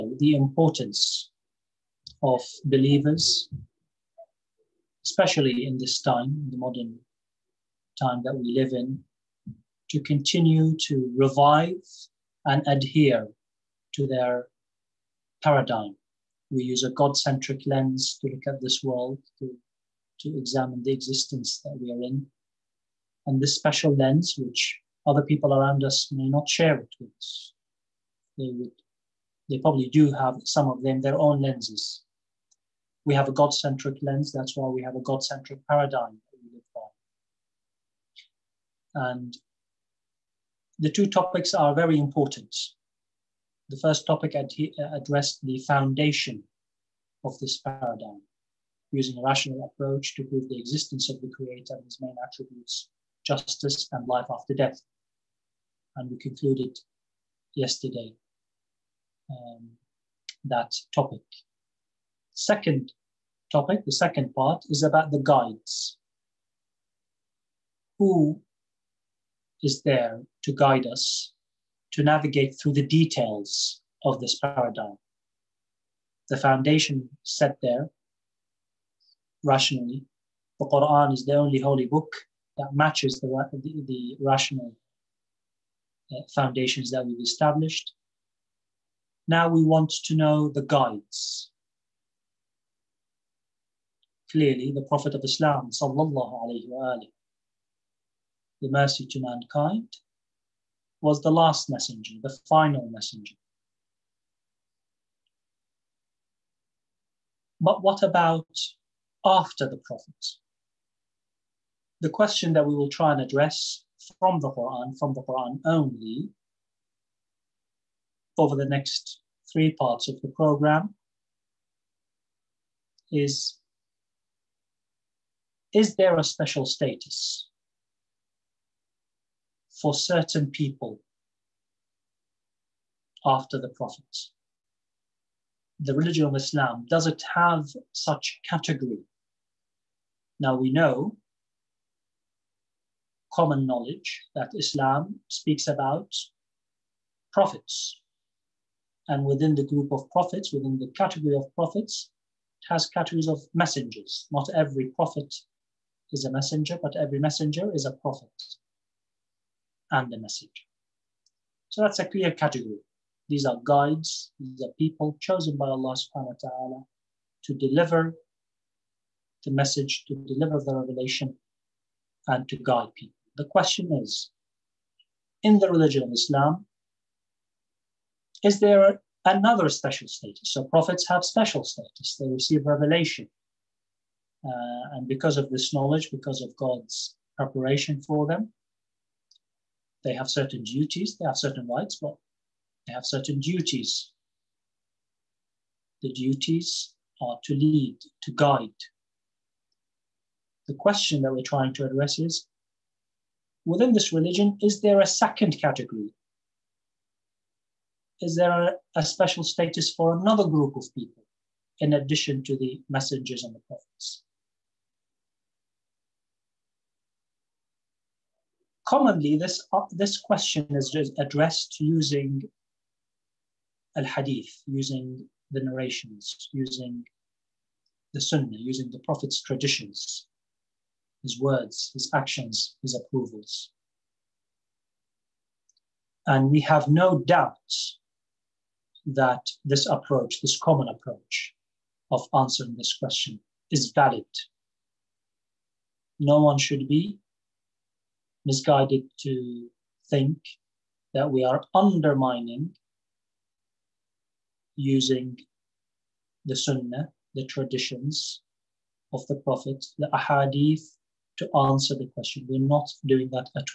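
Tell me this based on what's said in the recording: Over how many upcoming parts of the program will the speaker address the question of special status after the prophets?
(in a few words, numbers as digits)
3.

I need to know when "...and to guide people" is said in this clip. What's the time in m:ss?
2:52.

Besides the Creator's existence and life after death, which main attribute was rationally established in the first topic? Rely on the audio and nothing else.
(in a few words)
Justice.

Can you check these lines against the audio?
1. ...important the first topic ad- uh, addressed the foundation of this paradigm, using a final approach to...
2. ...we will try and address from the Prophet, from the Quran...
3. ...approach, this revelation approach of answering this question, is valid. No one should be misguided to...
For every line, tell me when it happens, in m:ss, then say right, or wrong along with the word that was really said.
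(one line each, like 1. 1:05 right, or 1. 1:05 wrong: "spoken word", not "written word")
1. 0:41 wrong: "rational", not "final"
2. 1:52 wrong: "Quran", not "Prophet"
3. 3:59 wrong: "common", not "revelation".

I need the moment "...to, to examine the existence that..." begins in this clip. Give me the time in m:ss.
0:19.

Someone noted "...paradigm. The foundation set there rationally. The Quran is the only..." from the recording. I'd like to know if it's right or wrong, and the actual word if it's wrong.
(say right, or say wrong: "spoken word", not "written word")
right.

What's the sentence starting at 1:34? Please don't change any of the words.
Clearly, the Prophet of Islam, sallallahu alayhi wa alayhi, the mercy to mankind, was the last messenger, the final messenger.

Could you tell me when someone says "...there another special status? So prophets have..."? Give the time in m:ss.
2:58.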